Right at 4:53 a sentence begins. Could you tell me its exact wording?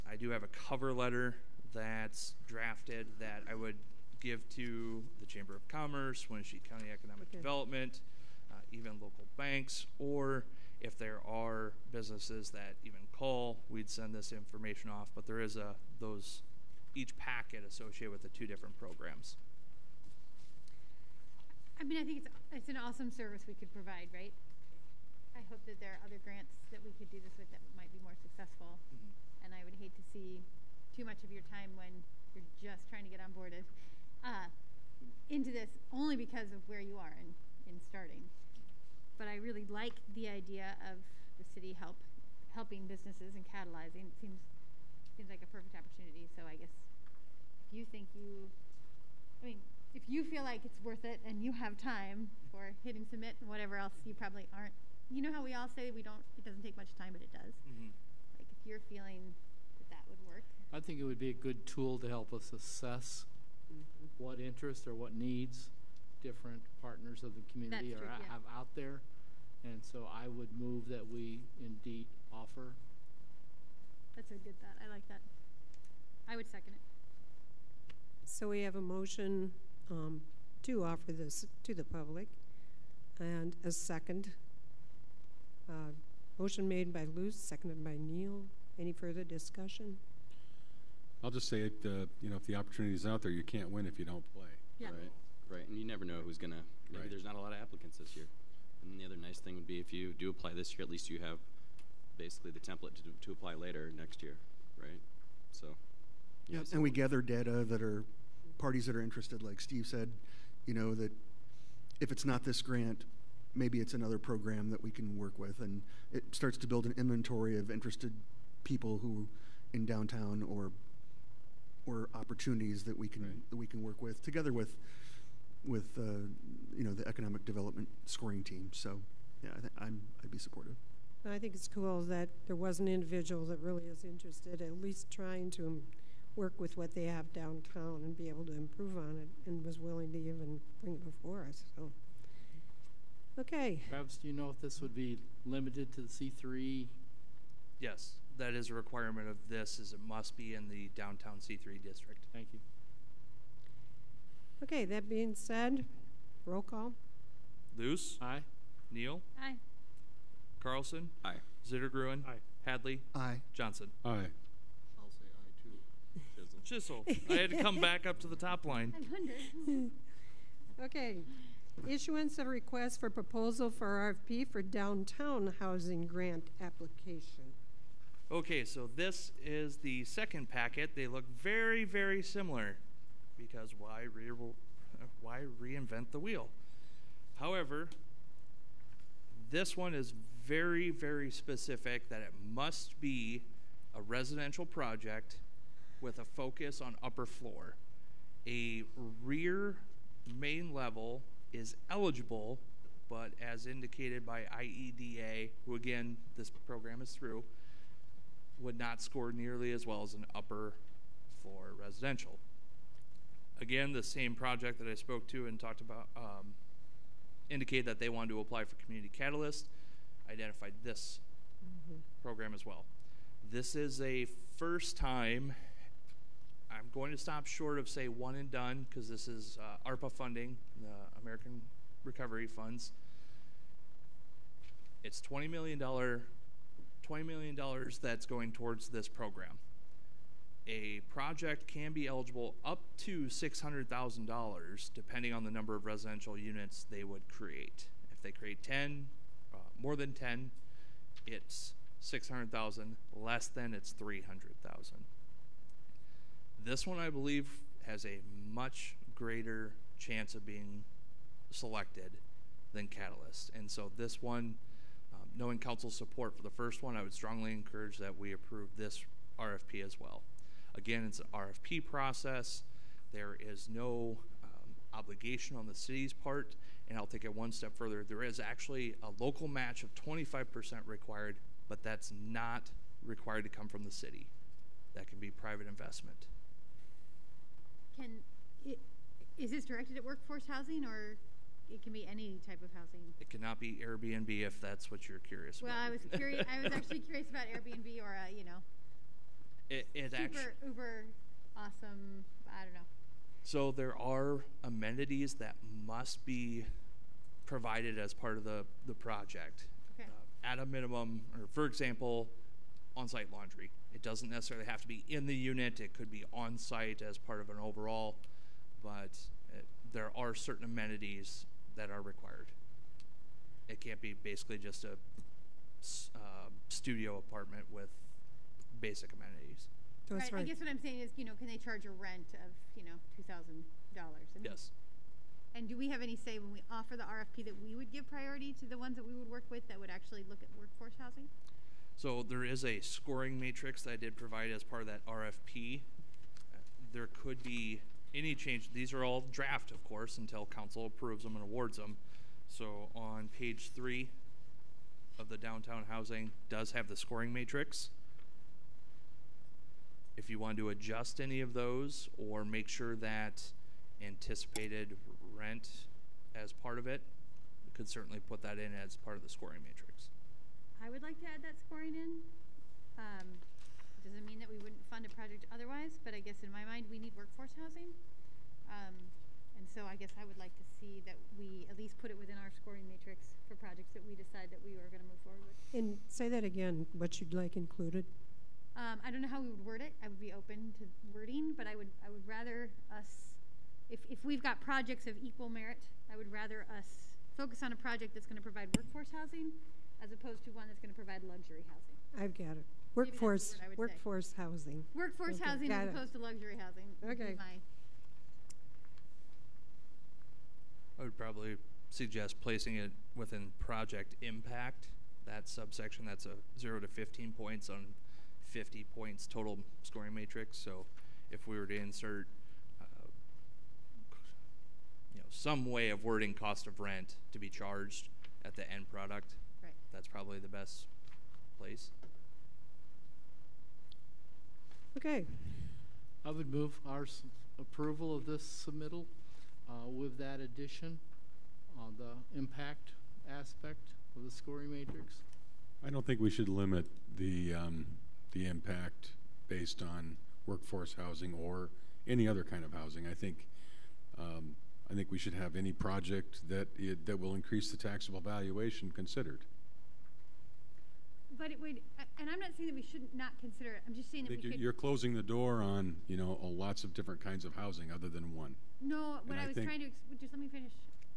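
It cannot be Airbnb if that's what you're curious well, about.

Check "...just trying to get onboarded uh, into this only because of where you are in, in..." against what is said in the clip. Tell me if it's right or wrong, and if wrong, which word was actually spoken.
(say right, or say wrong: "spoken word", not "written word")
right.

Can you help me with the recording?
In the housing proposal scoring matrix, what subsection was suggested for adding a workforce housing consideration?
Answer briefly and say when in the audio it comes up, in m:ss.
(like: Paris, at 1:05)
project impact, at 6:53.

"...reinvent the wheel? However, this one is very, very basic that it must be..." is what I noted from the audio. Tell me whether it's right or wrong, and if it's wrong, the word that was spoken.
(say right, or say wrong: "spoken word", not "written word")
wrong: "specific", not "basic".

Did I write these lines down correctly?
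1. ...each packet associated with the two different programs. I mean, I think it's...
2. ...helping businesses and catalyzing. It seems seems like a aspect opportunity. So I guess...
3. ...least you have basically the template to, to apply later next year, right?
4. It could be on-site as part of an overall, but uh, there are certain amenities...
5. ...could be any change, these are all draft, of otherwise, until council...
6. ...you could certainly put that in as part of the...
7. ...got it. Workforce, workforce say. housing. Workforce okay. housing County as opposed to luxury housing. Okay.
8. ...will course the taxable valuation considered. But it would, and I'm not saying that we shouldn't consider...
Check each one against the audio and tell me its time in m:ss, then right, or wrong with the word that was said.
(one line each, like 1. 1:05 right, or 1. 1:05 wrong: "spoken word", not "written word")
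1. 0:16 right
2. 0:42 wrong: "perfect", not "aspect"
3. 1:40 right
4. 5:15 right
5. 5:47 wrong: "course", not "otherwise"
6. 6:07 right
7. 6:42 wrong: "Got", not "County"
8. 7:37 wrong: "increase", not "course".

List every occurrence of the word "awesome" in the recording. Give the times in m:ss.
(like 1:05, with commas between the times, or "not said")
0:22, 5:01.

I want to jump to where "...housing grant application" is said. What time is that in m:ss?
2:55.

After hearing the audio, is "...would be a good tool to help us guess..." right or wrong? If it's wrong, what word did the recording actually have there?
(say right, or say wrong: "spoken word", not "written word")
wrong: "assess", not "guess".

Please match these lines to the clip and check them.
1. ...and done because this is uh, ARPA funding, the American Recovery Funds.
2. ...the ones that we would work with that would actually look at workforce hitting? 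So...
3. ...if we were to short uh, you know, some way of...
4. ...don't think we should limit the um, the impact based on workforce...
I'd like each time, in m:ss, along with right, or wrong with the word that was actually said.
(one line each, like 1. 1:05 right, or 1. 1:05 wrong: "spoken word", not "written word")
1. 3:48 right
2. 5:38 wrong: "housing", not "hitting"
3. 7:01 wrong: "insert", not "short"
4. 7:25 right.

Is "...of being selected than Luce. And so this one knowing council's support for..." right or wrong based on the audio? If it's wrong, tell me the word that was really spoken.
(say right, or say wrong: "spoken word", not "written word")
wrong: "Catalyst", not "Luce".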